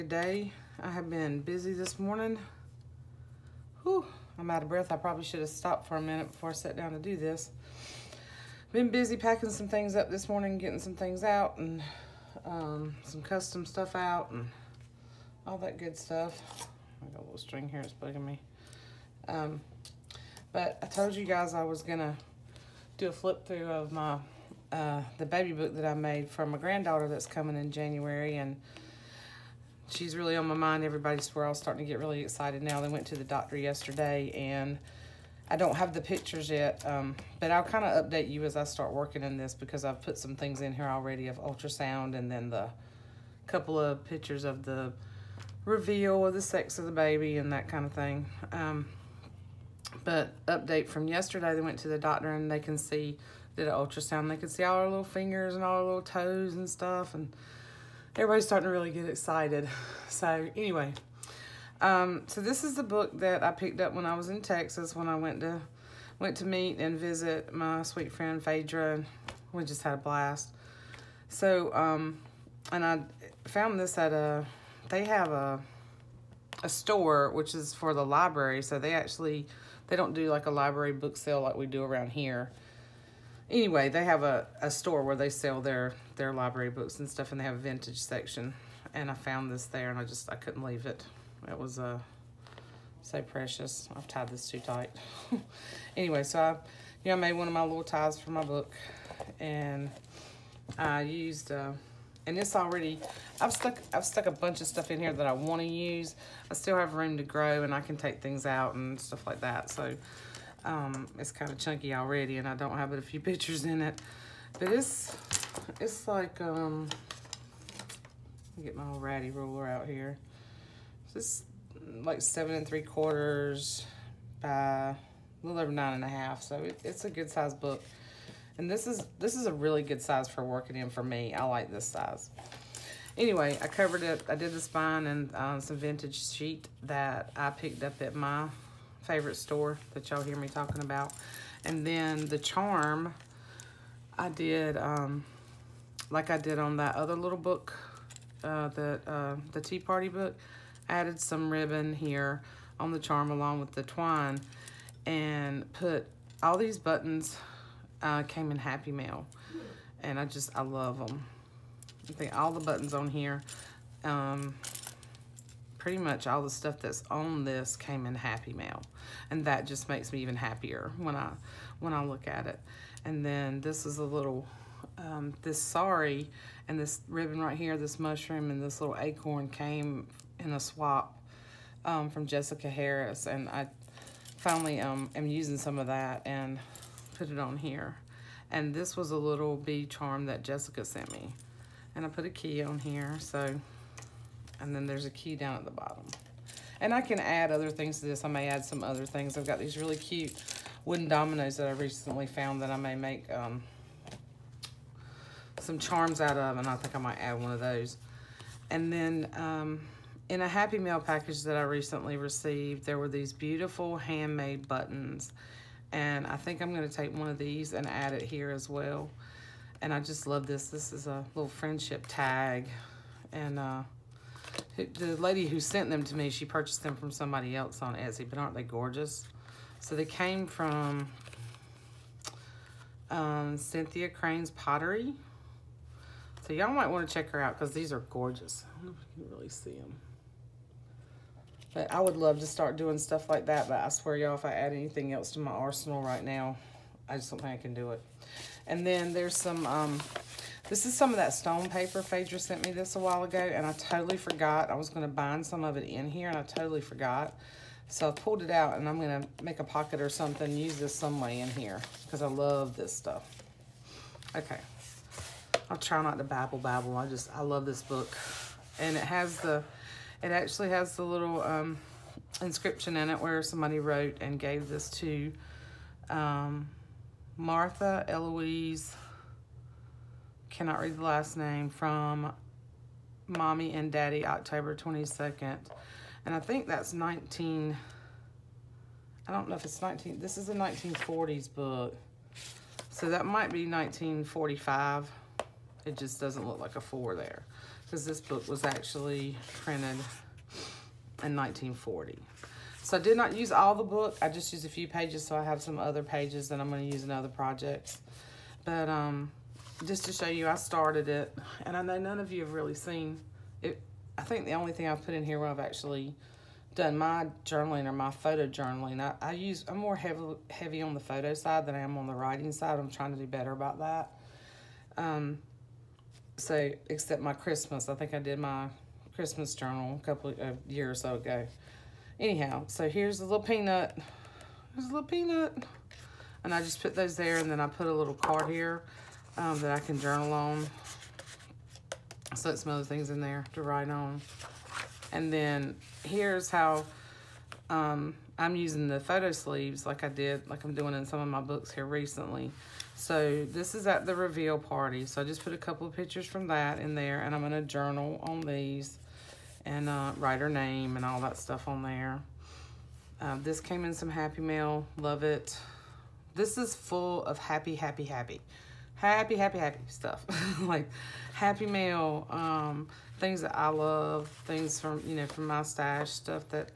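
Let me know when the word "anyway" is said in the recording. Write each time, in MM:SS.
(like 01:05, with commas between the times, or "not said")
01:00, 01:23, 01:35, 02:13.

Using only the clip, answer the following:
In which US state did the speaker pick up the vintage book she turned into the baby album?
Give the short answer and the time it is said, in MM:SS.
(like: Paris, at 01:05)
Texas, at 01:04.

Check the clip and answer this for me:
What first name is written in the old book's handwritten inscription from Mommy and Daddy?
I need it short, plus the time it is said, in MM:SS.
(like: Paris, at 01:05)
Martha Eloise, at 04:37.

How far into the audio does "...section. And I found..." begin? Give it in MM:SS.
01:27.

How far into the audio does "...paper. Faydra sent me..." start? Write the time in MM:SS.
04:11.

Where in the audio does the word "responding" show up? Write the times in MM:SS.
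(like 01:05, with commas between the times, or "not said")
not said.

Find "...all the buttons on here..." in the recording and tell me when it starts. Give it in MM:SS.
02:42.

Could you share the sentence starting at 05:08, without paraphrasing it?
But um, just to show you, I started it, and I know none of you have really seen it.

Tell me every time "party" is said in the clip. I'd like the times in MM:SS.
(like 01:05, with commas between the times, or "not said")
02:29, 05:54.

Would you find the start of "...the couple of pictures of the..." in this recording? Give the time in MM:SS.
00:42.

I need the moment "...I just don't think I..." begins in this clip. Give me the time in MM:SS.
04:07.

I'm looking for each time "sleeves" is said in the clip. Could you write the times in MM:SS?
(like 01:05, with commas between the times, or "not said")
05:49.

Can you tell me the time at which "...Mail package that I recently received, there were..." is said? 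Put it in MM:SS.
03:30.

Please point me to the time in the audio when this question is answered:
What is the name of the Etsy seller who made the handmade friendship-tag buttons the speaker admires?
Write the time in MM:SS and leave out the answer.
03:53.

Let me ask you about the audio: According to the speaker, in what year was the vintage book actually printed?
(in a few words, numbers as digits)
1940.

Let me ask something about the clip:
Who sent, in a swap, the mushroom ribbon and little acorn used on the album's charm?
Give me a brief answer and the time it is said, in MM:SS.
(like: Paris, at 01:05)
Jessica Harris, at 03:02.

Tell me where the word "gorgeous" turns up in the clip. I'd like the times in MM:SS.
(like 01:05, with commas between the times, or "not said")
03:48, 03:58.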